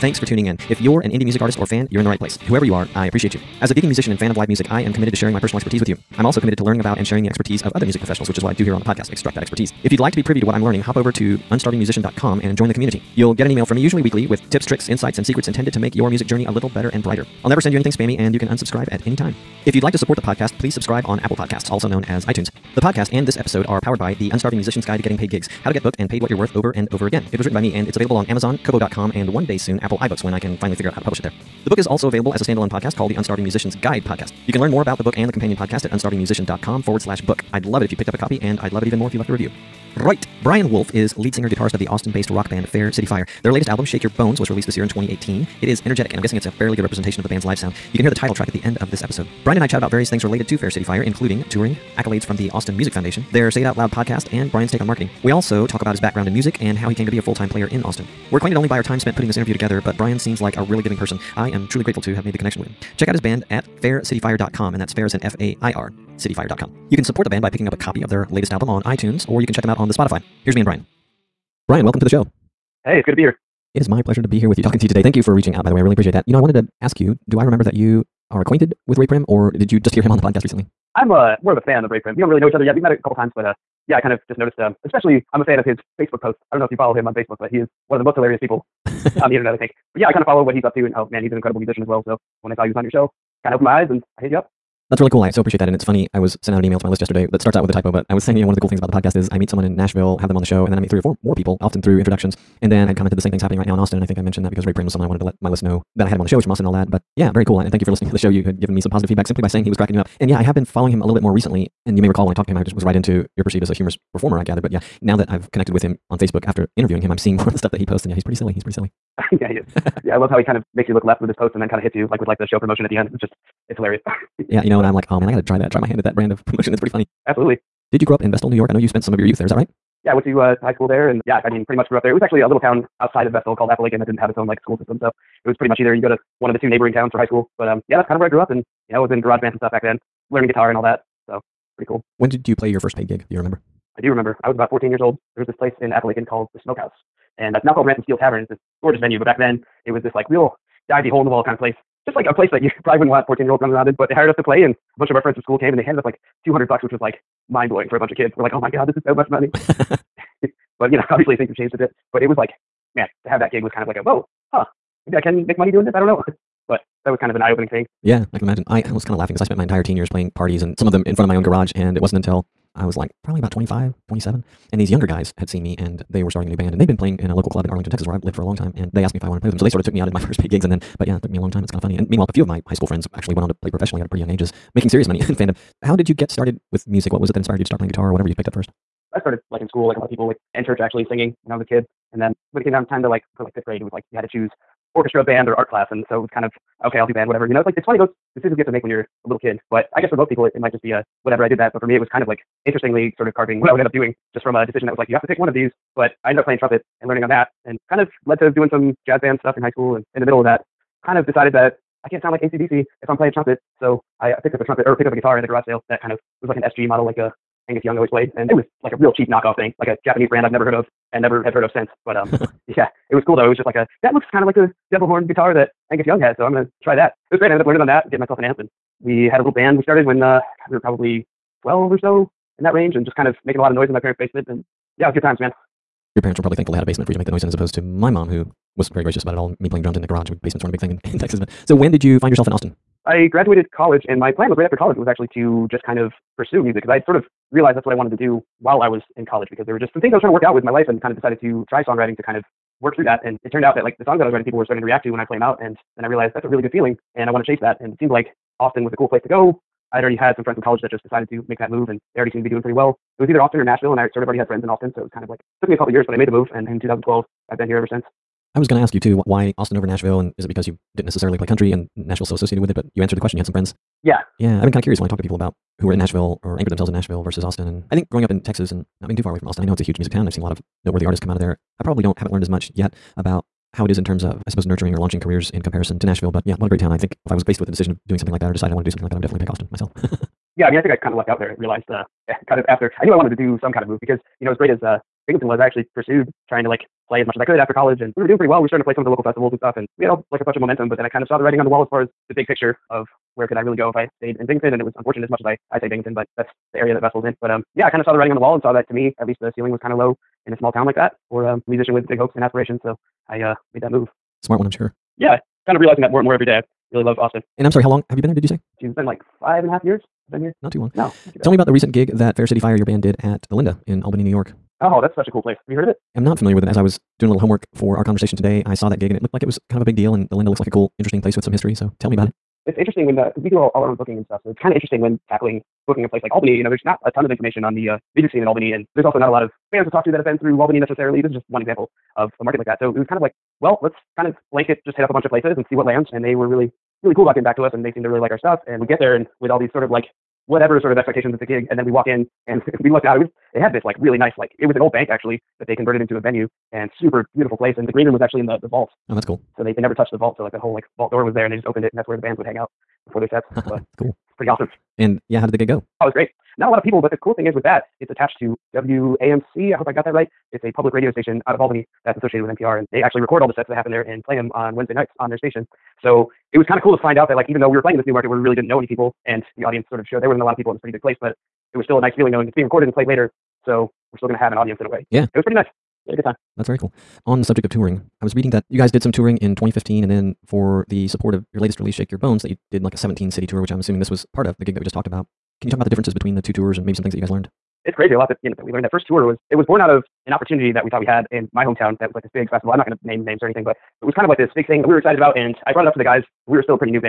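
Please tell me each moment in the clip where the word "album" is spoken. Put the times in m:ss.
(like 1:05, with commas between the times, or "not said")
0:43, 1:08.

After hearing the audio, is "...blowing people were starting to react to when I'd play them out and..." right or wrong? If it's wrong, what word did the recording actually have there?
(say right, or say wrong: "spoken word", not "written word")
wrong: "writing", not "blowing".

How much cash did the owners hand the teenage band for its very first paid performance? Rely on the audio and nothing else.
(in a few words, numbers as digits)
$200.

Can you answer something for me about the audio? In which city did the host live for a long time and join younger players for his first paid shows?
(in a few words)
Arlington, Texas.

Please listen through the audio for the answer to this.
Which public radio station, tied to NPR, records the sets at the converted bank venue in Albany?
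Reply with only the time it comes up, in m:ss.
6:08.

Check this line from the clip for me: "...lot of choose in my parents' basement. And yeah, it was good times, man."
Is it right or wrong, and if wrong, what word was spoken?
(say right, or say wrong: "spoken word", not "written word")
wrong: "noise", not "choose".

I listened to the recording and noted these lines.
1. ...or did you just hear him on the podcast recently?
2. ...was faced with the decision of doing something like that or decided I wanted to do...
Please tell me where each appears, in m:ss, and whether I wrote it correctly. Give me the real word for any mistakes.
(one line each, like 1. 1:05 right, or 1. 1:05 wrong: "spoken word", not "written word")
1. 1:19 right
2. 4:47 right.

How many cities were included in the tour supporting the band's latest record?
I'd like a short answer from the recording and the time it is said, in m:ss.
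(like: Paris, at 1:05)
17, at 6:32.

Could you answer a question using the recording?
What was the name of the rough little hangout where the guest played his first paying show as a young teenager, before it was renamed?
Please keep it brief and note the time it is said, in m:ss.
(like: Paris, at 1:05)
the Smokehouse, at 2:26.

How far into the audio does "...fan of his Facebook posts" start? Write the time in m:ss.
1:25.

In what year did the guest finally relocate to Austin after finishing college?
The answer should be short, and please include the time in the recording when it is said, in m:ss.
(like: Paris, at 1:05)
2012, at 4:26.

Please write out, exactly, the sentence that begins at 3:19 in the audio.
But I guess for most people, it, it might just be a whatever.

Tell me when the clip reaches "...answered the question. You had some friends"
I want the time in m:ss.
4:33.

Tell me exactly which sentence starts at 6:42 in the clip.
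I'm not going to name names or anything, but it was kind of like this big thing that we were excited about.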